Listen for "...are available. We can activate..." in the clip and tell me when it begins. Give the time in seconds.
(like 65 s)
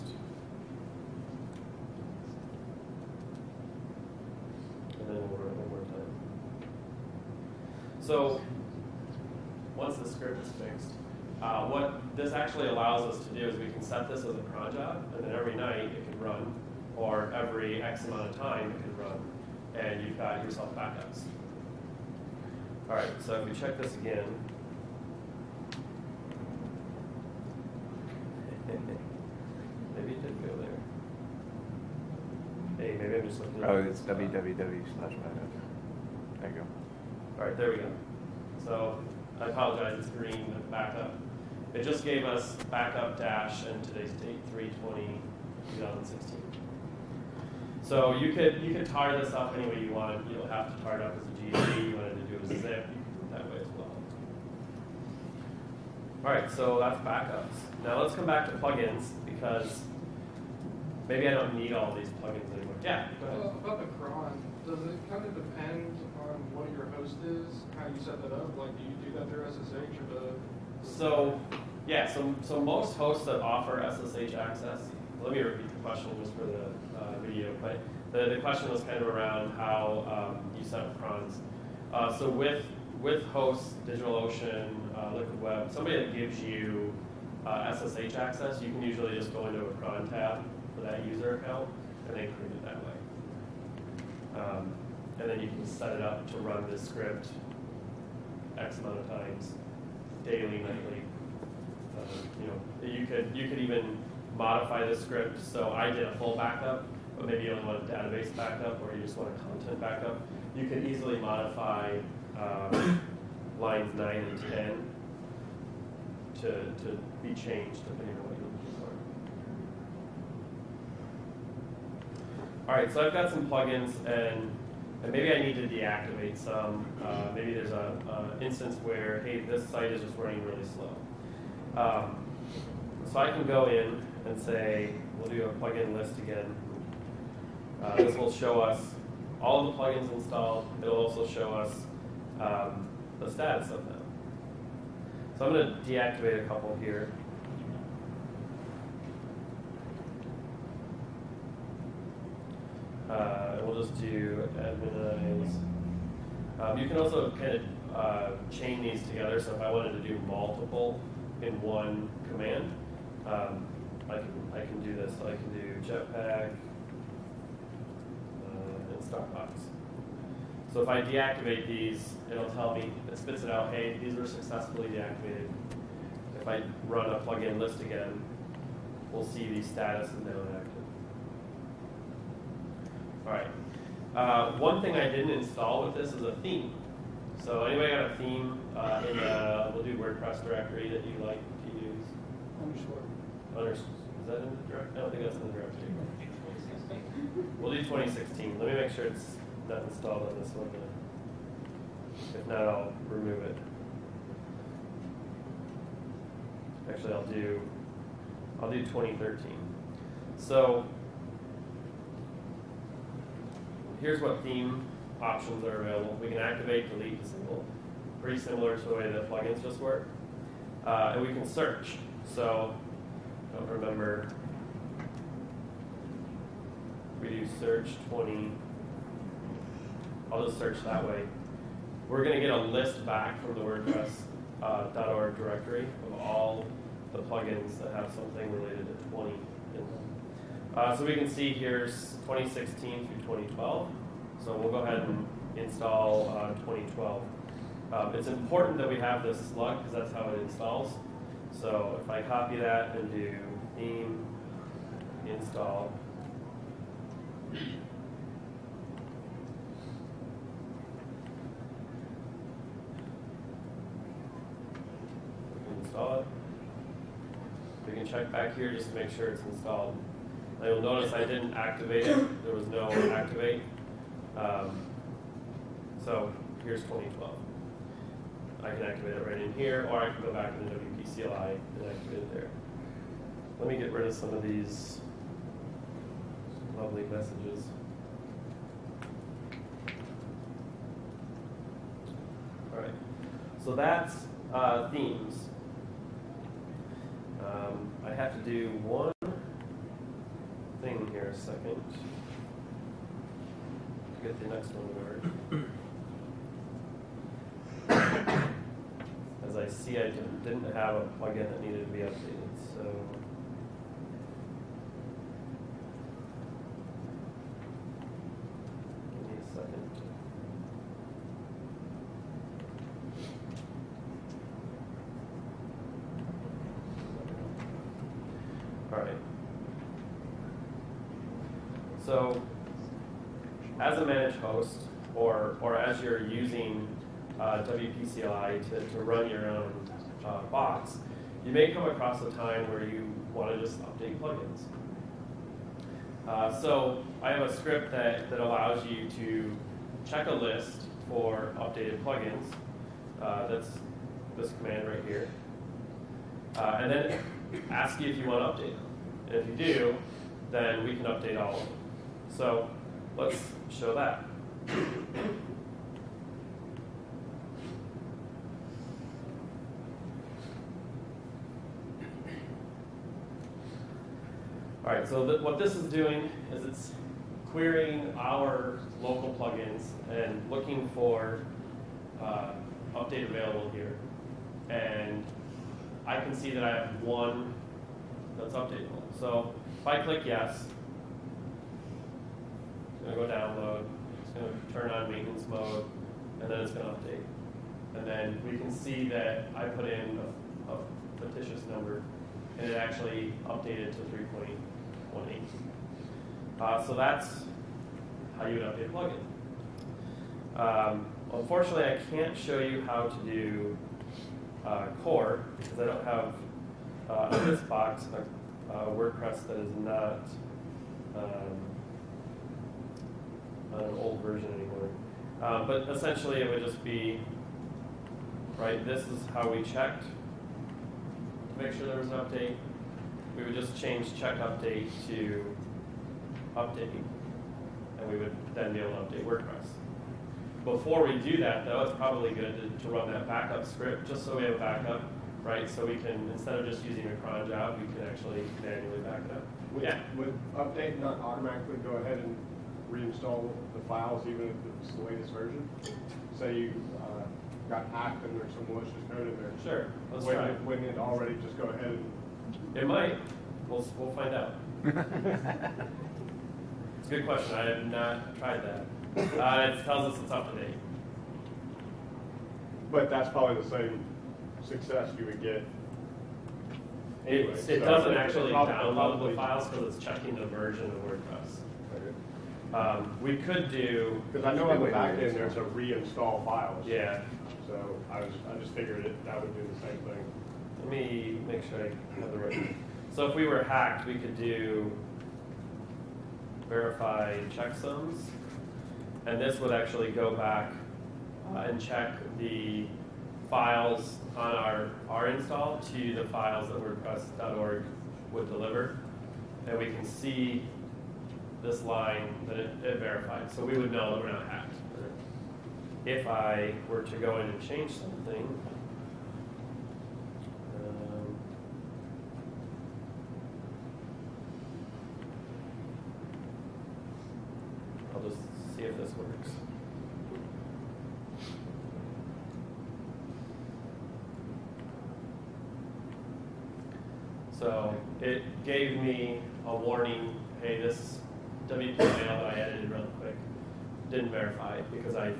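215 s.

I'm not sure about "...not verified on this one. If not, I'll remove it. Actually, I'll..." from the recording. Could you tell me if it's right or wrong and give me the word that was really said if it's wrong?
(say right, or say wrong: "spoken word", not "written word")
wrong: "installed", not "verified".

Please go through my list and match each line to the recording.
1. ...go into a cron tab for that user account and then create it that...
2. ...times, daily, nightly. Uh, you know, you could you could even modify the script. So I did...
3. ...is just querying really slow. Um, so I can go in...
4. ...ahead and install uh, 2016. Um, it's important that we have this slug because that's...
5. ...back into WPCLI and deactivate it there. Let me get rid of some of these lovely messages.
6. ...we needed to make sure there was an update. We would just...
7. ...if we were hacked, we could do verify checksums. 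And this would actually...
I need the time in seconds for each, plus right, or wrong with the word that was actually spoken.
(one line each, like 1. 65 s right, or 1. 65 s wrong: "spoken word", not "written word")
1. 89 s right
2. 99 s right
3. 129 s wrong: "running", not "querying"
4. 244 s wrong: "2012", not "2016"
5. 280 s wrong: "activate", not "deactivate"
6. 429 s wrong: "checked", not "needed"
7. 493 s right.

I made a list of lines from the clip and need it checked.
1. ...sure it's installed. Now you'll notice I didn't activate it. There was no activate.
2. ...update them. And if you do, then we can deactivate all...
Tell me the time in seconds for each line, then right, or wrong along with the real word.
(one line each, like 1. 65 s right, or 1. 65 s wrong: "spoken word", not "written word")
1. 269 s right
2. 358 s wrong: "update", not "deactivate".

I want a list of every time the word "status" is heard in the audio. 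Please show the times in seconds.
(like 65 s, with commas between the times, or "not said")
143 s, 179 s.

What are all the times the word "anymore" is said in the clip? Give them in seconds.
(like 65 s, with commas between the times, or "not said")
62 s, 424 s.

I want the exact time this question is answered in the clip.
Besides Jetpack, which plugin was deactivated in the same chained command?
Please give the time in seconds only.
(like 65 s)
169 s.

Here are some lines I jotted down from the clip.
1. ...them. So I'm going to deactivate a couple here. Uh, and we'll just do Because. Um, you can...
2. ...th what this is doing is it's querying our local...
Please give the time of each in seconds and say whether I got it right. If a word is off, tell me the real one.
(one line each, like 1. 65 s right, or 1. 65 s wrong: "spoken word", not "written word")
1. 143 s wrong: "Edmonds", not "Because"
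2. 375 s right.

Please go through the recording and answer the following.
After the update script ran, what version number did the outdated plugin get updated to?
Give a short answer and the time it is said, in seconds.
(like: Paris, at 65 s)
3.18, at 404 s.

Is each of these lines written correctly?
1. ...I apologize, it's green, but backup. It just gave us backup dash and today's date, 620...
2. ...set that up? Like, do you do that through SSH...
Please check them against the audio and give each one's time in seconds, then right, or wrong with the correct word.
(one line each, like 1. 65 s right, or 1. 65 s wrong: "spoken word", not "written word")
1. 39 s wrong: "320", not "620"
2. 68 s right.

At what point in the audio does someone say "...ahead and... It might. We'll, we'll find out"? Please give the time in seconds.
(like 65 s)
461 s.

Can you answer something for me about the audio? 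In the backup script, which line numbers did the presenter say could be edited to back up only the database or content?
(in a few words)
9 and 10.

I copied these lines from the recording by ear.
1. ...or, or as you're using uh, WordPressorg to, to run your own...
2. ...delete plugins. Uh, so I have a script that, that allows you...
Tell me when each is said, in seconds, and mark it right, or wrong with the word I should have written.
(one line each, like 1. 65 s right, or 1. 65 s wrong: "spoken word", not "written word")
1. 335 s wrong: "WPCLI", not "WordPressorg"
2. 343 s wrong: "update", not "delete".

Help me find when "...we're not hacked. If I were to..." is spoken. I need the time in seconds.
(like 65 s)
514 s.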